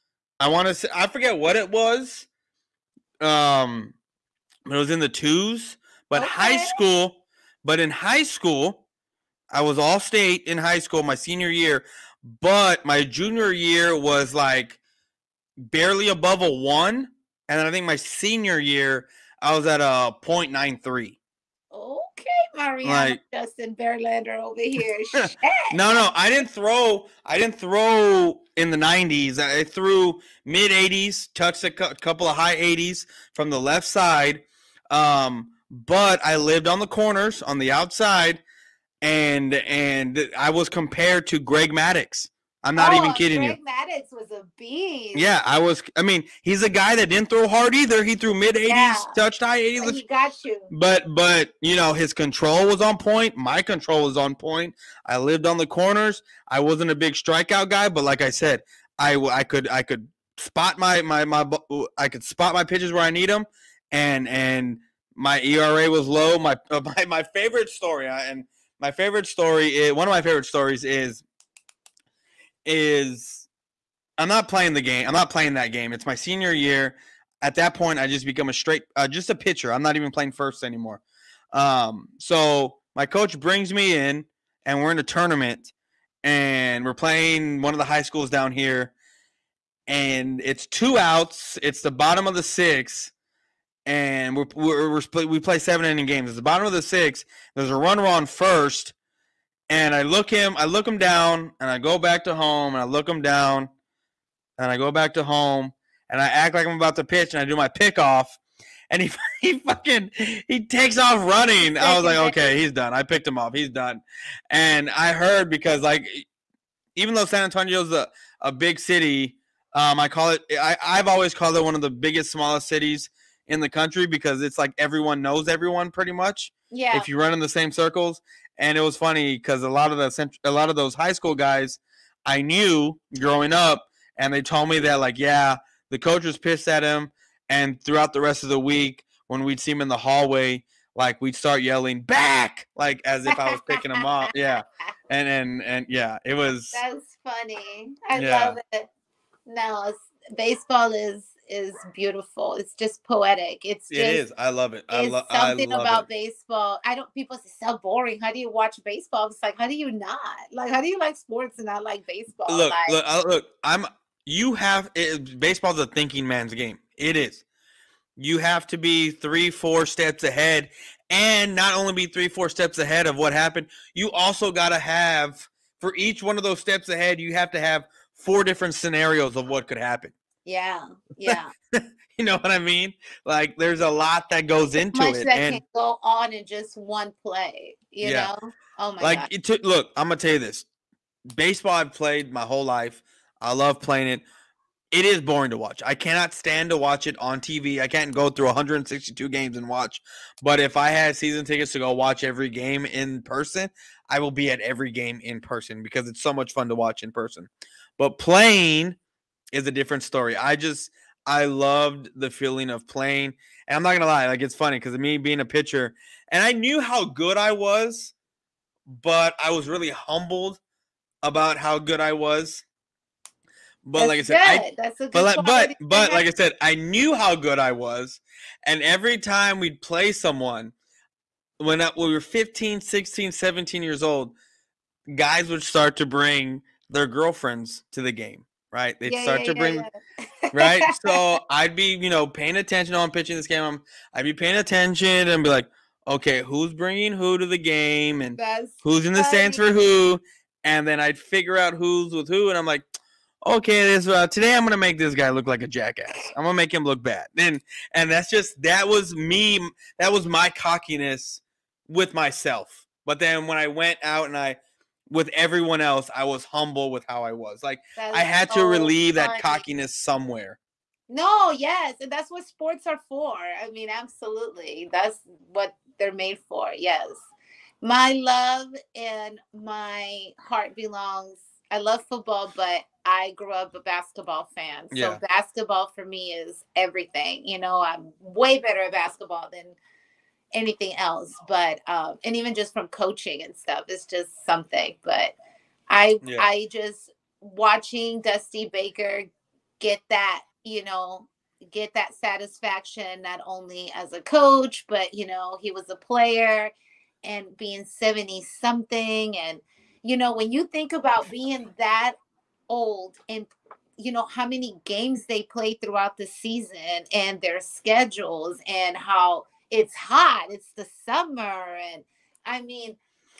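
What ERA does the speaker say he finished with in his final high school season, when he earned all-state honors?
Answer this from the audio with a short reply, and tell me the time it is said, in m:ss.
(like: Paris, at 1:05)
0.93, at 0:20.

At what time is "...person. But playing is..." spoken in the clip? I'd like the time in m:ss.
3:27.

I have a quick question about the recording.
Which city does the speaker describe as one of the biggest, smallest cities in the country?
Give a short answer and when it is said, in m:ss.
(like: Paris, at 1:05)
San Antonio, at 1:57.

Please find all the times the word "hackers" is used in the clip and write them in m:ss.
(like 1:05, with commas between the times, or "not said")
not said.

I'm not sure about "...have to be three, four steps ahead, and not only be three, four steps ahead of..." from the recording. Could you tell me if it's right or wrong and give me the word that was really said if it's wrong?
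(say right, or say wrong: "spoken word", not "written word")
right.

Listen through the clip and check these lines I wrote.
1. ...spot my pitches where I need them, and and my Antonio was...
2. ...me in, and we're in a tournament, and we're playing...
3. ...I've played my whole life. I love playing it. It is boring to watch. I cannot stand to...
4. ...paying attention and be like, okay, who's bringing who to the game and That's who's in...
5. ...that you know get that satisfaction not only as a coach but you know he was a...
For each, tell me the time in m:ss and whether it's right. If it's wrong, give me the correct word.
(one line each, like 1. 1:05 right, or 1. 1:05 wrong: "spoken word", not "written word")
1. 1:02 wrong: "ERA", not "Antonio"
2. 1:23 right
3. 3:11 right
4. 4:04 right
5. 5:00 right.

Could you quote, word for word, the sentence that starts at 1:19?
I'm not even playing first anymore.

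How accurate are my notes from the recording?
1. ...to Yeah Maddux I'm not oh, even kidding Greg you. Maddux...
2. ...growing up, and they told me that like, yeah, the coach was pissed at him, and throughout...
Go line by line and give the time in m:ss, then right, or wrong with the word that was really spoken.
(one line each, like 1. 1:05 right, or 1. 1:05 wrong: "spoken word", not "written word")
1. 0:41 wrong: "Greg", not "Yeah"
2. 2:13 right.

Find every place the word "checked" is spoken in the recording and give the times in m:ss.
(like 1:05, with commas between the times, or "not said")
not said.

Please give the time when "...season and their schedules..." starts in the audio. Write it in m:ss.
5:16.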